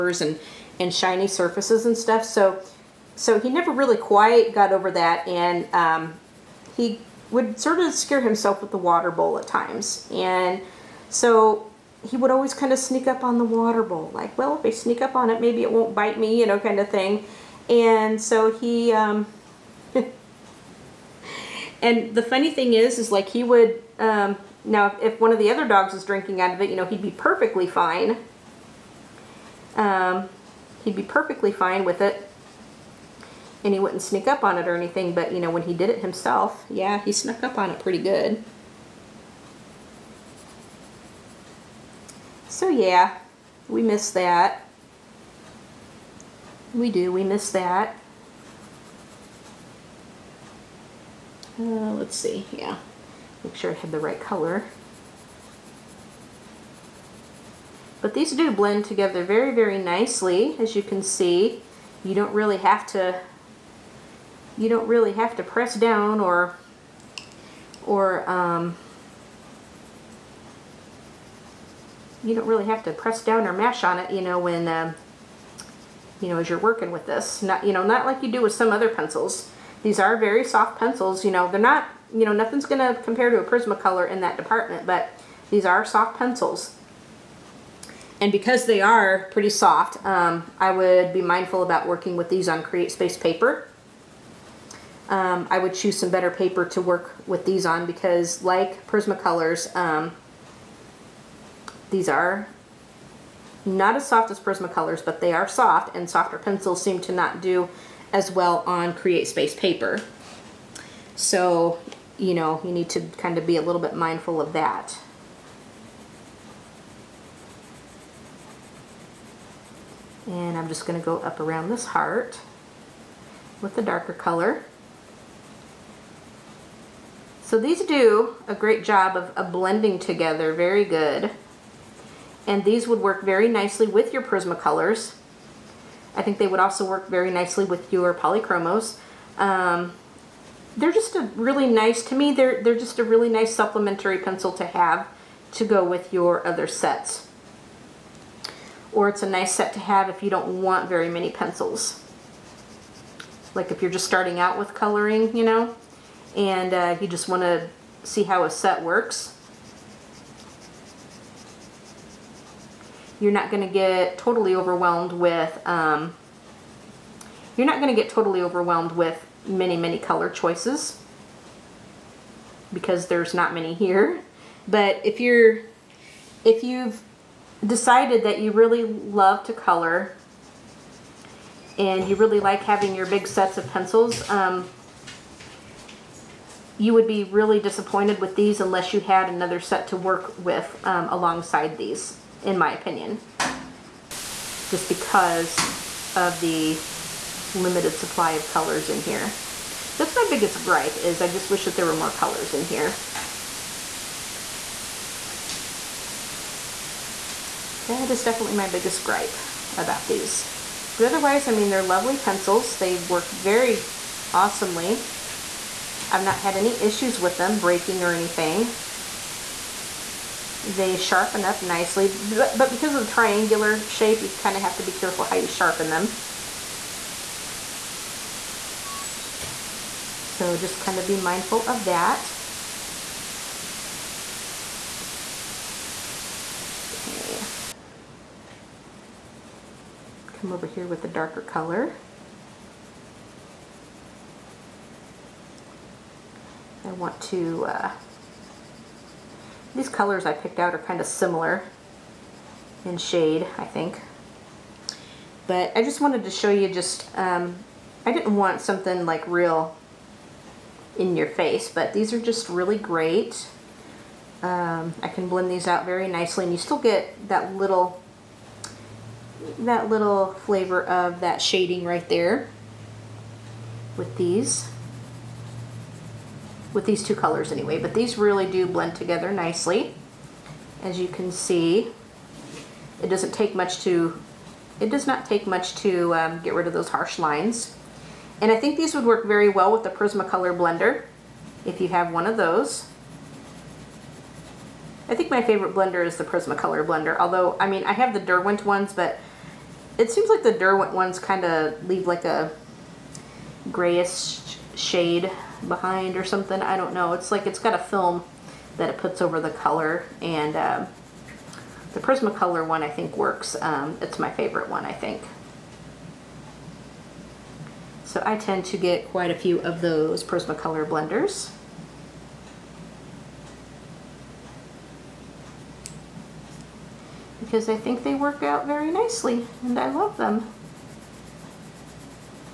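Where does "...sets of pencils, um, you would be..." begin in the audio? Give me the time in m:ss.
3:03.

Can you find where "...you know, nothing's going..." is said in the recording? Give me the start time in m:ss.
1:22.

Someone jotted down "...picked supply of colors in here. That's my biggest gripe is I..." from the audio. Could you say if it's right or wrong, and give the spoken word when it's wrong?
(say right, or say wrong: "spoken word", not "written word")
wrong: "limited", not "picked".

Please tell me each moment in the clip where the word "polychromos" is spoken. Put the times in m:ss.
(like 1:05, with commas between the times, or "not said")
2:18.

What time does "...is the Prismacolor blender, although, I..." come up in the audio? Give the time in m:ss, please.
4:56.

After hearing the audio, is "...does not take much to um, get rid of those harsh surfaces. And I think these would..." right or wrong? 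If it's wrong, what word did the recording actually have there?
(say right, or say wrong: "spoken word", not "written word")
wrong: "lines", not "surfaces".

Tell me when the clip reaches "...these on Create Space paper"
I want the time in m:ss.
1:32.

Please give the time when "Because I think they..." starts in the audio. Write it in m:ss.
5:27.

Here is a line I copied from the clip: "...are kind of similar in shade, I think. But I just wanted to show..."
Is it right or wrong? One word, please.
right.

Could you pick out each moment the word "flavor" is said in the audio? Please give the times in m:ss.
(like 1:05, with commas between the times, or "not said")
4:30.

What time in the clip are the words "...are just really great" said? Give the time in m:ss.
4:22.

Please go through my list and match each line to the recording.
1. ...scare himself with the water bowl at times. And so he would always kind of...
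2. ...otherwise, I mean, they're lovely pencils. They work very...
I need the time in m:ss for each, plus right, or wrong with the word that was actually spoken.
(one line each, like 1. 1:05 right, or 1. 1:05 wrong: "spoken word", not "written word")
1. 0:07 right
2. 3:31 right.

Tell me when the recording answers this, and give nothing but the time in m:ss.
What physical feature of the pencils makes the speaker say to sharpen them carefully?
3:43.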